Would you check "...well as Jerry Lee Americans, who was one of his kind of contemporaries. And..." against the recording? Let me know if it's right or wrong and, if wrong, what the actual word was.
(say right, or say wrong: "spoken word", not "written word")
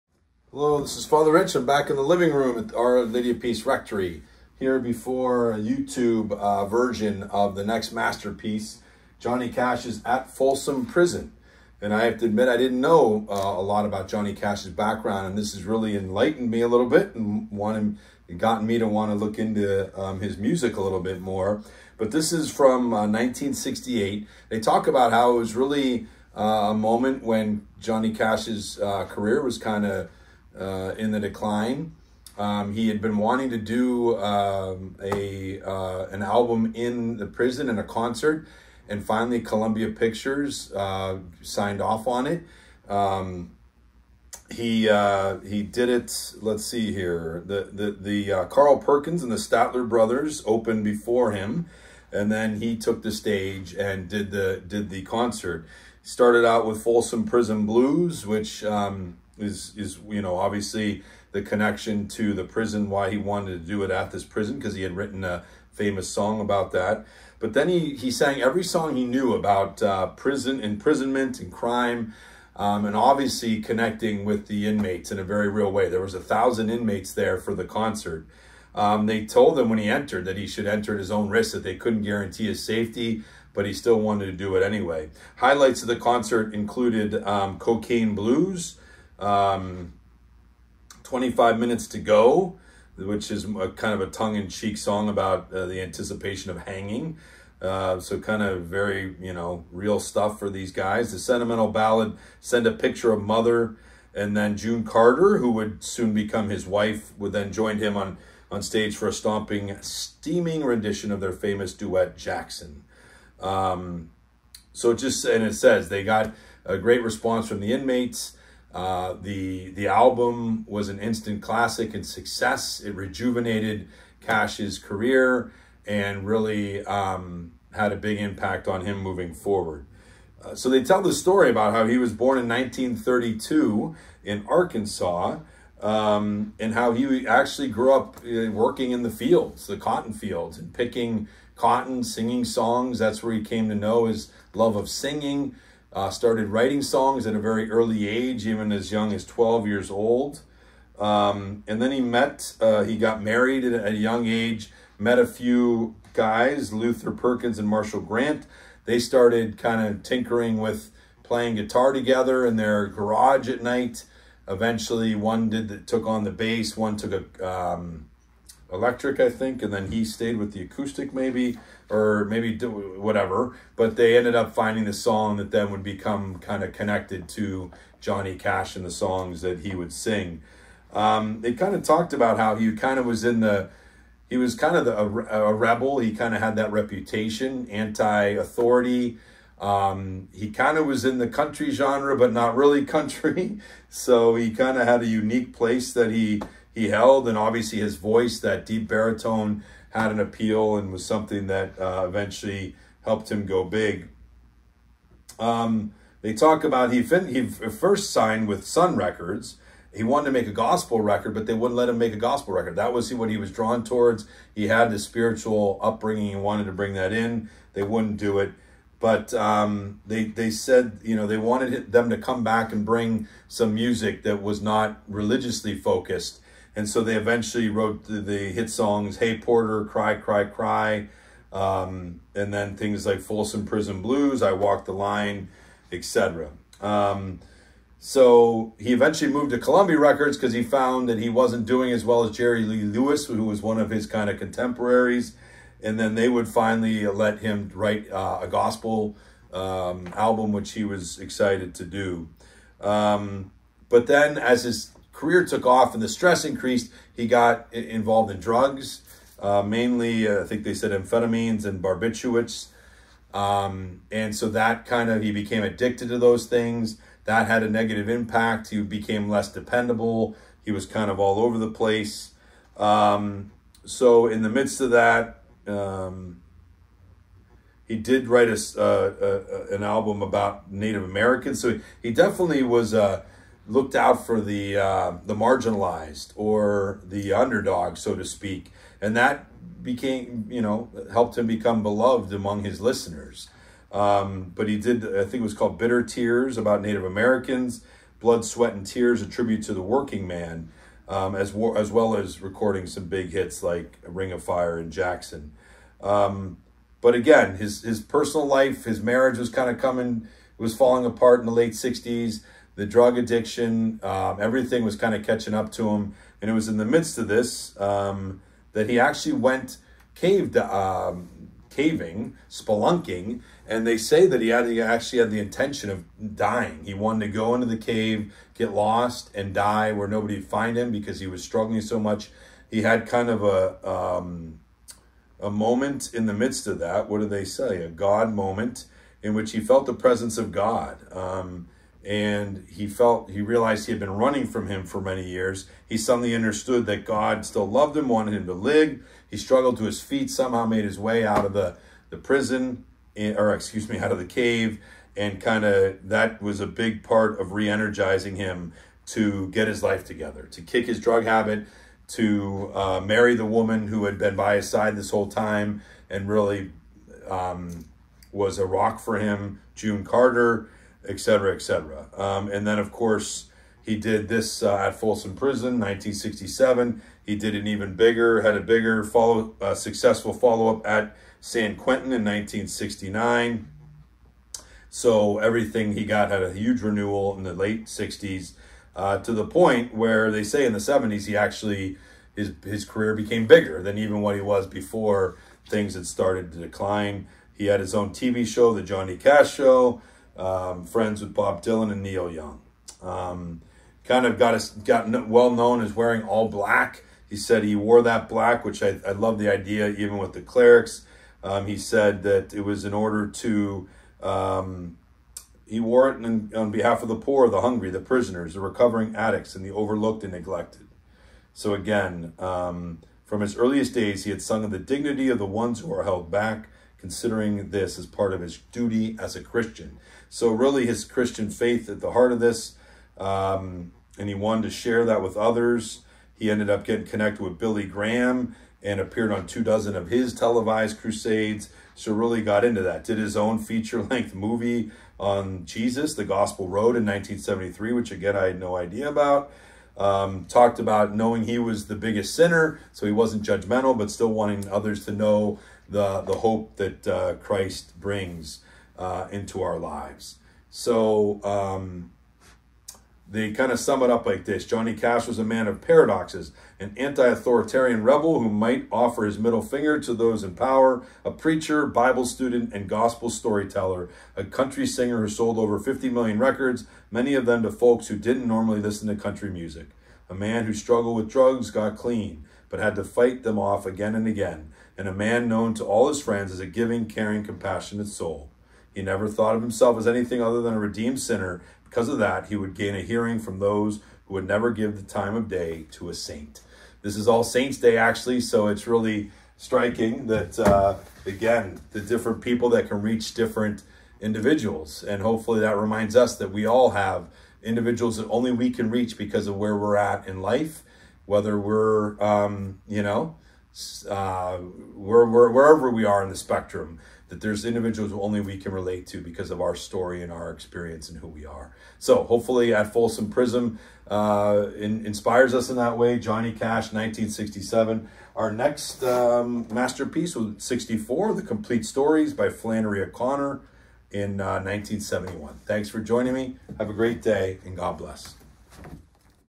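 wrong: "Lewis", not "Americans".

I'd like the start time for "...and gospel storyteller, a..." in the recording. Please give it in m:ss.
7:52.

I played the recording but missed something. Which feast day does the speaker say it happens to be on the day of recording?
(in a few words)
All Saints Day.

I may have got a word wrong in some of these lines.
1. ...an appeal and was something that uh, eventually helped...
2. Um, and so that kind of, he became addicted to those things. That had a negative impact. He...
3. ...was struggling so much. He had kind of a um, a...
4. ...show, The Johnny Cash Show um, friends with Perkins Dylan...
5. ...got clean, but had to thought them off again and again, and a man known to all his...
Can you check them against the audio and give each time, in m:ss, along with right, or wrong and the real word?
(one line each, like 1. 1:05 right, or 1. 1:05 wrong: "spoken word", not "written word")
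1. 3:20 right
2. 4:23 right
3. 5:31 right
4. 6:38 wrong: "Bob", not "Perkins"
5. 8:01 wrong: "fight", not "thought".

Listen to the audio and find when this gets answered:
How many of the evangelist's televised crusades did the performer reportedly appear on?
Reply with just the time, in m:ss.
7:19.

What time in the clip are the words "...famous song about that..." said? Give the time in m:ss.
1:05.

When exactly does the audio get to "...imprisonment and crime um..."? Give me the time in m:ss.
1:10.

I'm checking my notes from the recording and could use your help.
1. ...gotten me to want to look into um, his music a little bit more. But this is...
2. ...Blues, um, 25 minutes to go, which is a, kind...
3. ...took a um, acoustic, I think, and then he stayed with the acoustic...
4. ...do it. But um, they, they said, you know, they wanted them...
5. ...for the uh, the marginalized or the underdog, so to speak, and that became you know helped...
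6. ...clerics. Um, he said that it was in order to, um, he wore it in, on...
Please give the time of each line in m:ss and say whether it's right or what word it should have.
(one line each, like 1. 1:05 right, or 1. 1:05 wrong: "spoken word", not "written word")
1. 0:18 right
2. 1:28 right
3. 2:46 wrong: "electric", not "acoustic"
4. 3:38 right
5. 4:44 right
6. 6:50 right.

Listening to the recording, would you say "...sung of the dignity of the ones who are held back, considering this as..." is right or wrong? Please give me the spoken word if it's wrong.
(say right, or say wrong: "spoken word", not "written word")
right.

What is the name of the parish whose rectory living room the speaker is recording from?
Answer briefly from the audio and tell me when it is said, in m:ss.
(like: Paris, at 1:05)
Our Lady of Peace, at 0:02.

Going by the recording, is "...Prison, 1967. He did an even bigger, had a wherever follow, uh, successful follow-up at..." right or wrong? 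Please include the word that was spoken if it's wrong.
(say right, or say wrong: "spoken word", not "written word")
wrong: "bigger", not "wherever".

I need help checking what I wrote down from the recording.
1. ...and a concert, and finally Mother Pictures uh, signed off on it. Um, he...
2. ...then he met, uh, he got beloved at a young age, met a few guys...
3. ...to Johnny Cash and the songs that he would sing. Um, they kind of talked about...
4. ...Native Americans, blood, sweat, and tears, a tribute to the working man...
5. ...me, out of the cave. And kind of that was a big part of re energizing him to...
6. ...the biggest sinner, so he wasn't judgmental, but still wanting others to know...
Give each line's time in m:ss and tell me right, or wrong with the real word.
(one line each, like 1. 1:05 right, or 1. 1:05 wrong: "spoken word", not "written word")
1. 0:37 wrong: "Columbia", not "Mother"
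2. 2:31 wrong: "married", not "beloved"
3. 2:57 right
4. 4:56 right
5. 5:53 right
6. 7:31 right.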